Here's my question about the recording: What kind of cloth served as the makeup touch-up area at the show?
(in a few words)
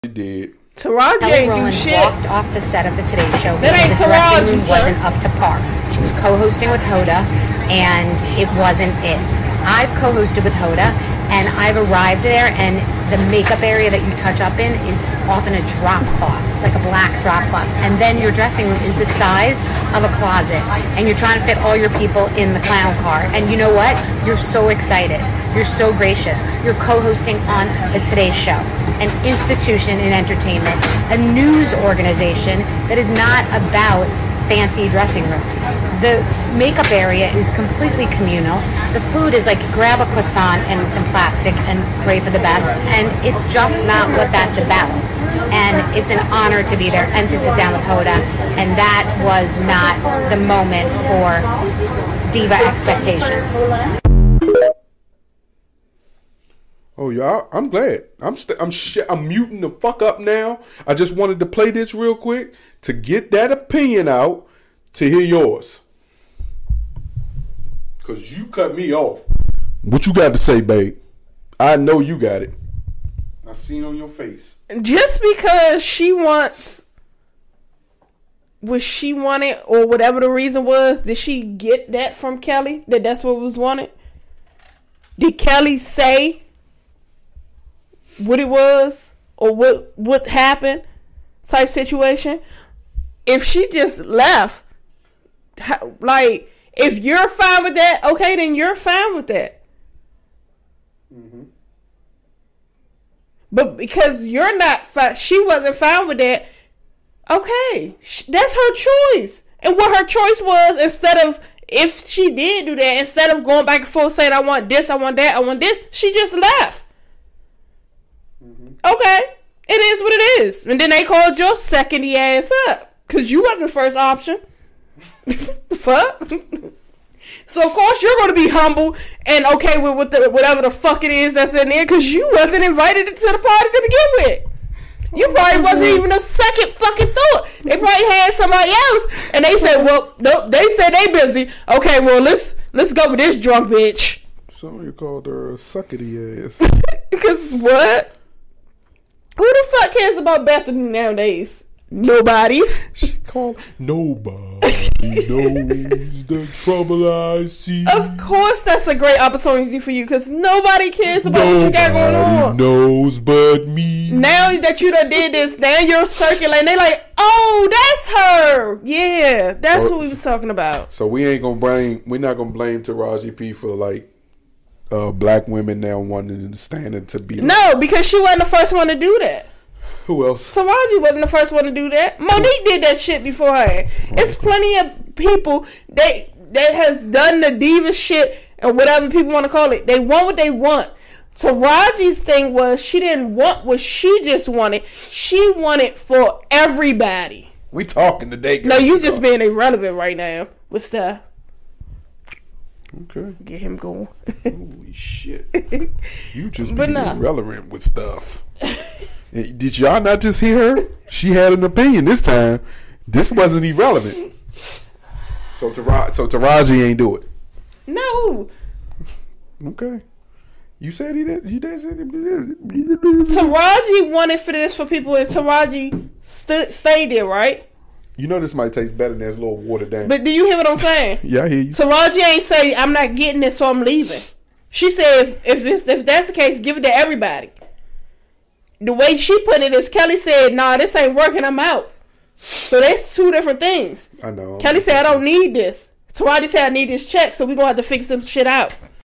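A black drop cloth.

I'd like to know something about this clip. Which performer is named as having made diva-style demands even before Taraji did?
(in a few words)
Mo'Nique.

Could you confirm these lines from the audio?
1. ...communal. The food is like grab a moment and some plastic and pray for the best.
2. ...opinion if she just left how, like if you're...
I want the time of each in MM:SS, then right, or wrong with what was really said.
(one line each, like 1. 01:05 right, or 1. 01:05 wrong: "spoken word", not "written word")
1. 00:38 wrong: "croissant", not "moment"
2. 01:31 wrong: "situation", not "opinion".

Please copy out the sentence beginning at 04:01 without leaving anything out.
I'm out." So that's two different things.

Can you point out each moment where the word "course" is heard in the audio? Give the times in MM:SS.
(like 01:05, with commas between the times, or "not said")
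02:07, 02:38.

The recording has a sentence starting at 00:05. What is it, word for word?
She was co-hosting with Hoda, and it wasn't it.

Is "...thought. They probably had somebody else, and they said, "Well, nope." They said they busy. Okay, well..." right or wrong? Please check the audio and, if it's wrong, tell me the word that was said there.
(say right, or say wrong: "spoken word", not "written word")
right.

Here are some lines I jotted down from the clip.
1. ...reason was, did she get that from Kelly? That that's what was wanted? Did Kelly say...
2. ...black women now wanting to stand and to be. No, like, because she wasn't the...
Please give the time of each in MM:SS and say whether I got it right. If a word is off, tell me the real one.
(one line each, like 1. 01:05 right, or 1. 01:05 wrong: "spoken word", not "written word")
1. 01:20 right
2. 02:55 right.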